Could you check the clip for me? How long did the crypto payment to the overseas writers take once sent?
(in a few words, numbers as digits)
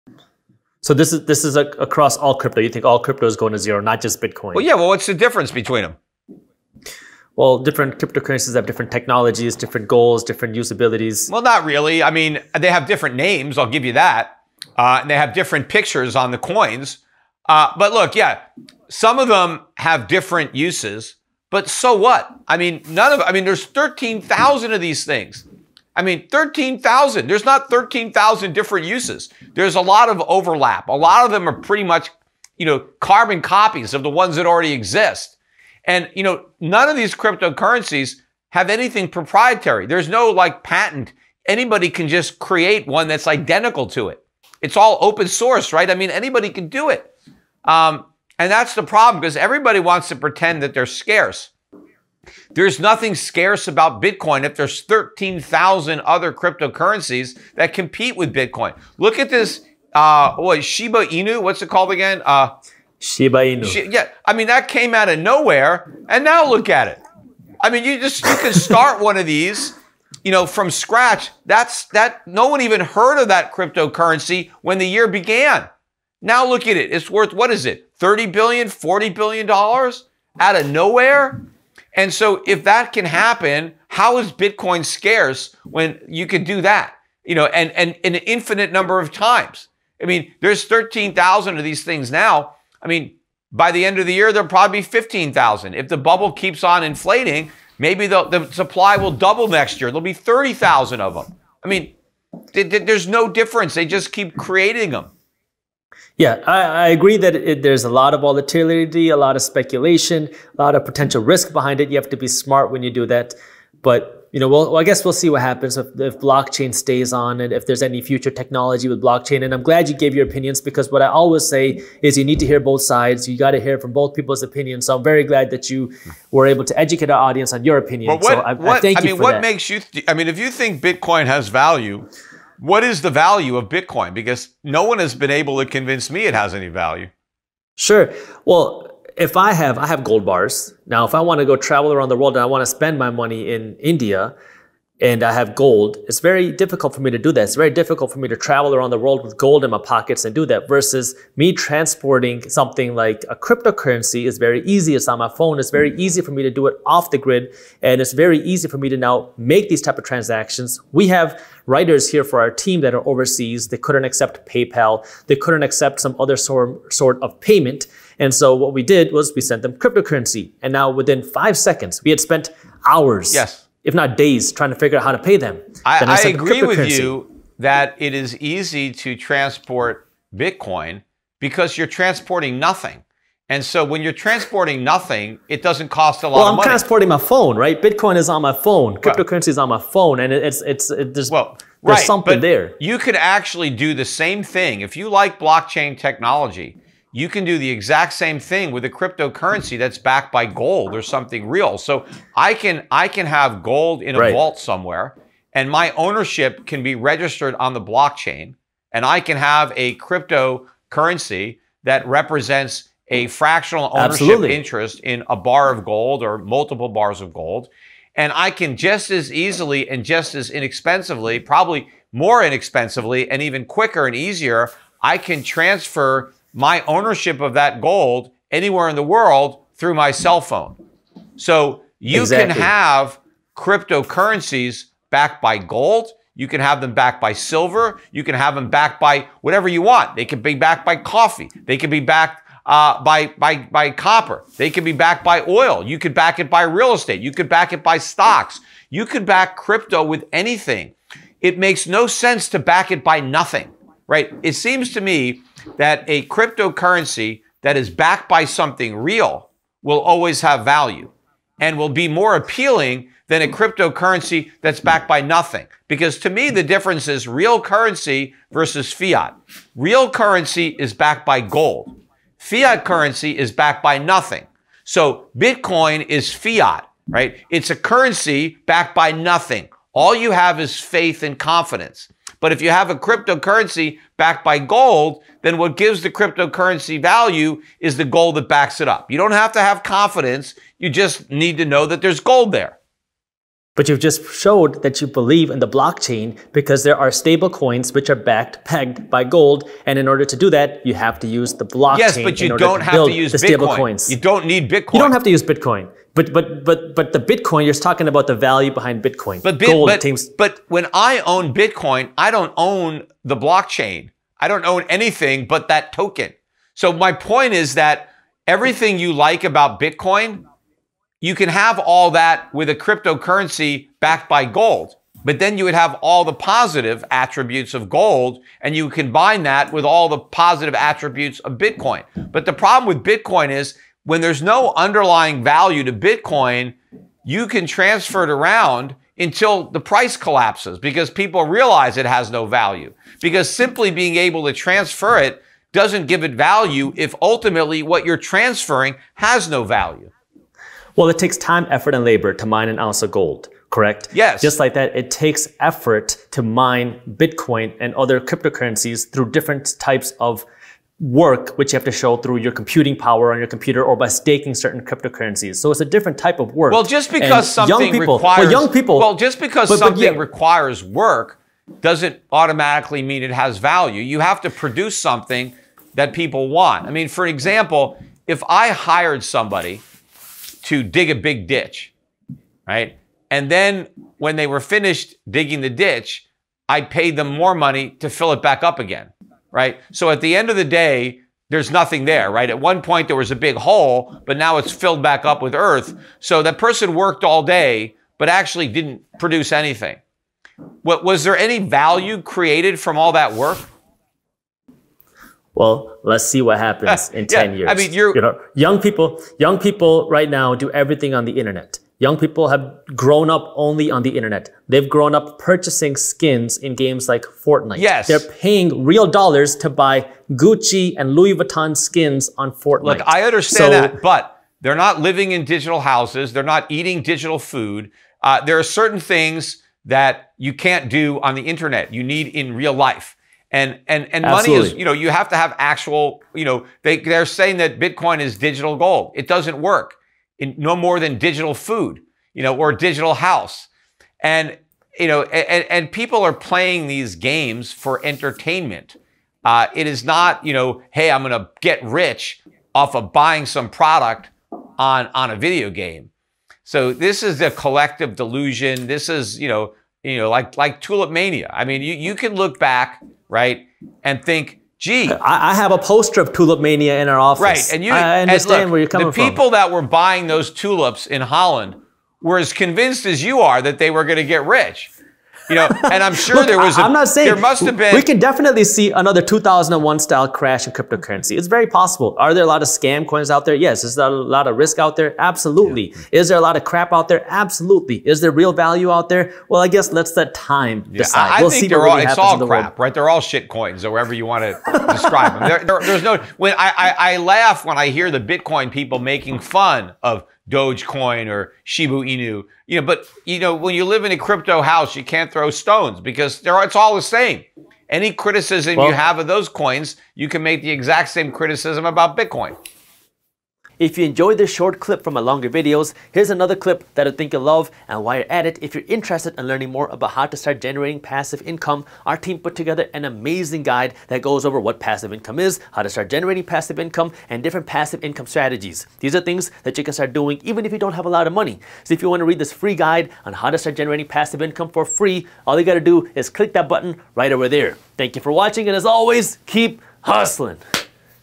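5 seconds.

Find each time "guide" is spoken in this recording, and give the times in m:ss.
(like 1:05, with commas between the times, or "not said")
8:43, 8:52.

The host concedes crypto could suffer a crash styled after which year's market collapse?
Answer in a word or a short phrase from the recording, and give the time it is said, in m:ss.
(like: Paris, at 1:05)
2001, at 7:59.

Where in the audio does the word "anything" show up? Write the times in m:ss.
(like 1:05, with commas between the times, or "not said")
0:38, 4:10, 5:14, 6:39.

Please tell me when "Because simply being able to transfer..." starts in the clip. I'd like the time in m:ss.
5:43.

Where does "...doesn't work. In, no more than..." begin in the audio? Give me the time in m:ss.
7:19.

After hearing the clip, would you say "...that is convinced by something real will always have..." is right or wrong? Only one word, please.
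wrong.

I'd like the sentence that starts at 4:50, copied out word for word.
You just need to know that there's gold there.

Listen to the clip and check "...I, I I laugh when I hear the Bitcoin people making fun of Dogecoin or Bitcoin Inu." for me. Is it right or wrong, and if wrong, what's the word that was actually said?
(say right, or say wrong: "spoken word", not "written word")
wrong: "Shiba", not "Bitcoin".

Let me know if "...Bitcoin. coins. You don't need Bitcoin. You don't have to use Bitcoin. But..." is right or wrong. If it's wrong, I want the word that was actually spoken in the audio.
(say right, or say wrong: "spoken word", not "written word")
right.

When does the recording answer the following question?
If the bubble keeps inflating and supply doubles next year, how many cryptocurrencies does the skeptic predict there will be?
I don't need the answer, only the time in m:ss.
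1:40.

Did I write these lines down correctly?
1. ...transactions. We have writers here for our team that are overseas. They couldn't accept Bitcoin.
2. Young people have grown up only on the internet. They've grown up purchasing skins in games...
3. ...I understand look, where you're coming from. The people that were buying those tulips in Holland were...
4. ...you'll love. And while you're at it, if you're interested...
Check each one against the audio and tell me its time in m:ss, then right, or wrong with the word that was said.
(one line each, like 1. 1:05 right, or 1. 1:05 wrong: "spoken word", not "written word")
1. 2:40 wrong: "PayPal", not "Bitcoin"
2. 6:51 right
3. 7:47 right
4. 8:37 right.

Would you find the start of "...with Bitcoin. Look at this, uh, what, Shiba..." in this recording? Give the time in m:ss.
0:58.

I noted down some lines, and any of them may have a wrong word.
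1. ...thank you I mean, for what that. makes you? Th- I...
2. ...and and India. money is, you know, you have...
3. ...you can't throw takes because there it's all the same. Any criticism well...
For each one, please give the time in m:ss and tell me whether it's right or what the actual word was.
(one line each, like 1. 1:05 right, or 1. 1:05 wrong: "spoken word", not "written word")
1. 2:08 right
2. 7:13 wrong: "Absolutely", not "India"
3. 8:24 wrong: "stones", not "takes".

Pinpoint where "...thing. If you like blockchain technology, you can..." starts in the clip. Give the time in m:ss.
3:14.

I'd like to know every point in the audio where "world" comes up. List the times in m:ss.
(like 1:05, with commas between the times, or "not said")
2:22, 2:28, 3:49.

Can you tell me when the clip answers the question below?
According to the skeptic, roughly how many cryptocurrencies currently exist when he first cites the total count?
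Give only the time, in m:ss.
0:23.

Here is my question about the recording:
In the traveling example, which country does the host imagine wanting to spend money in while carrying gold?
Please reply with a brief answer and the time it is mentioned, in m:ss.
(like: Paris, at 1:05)
India, at 2:23.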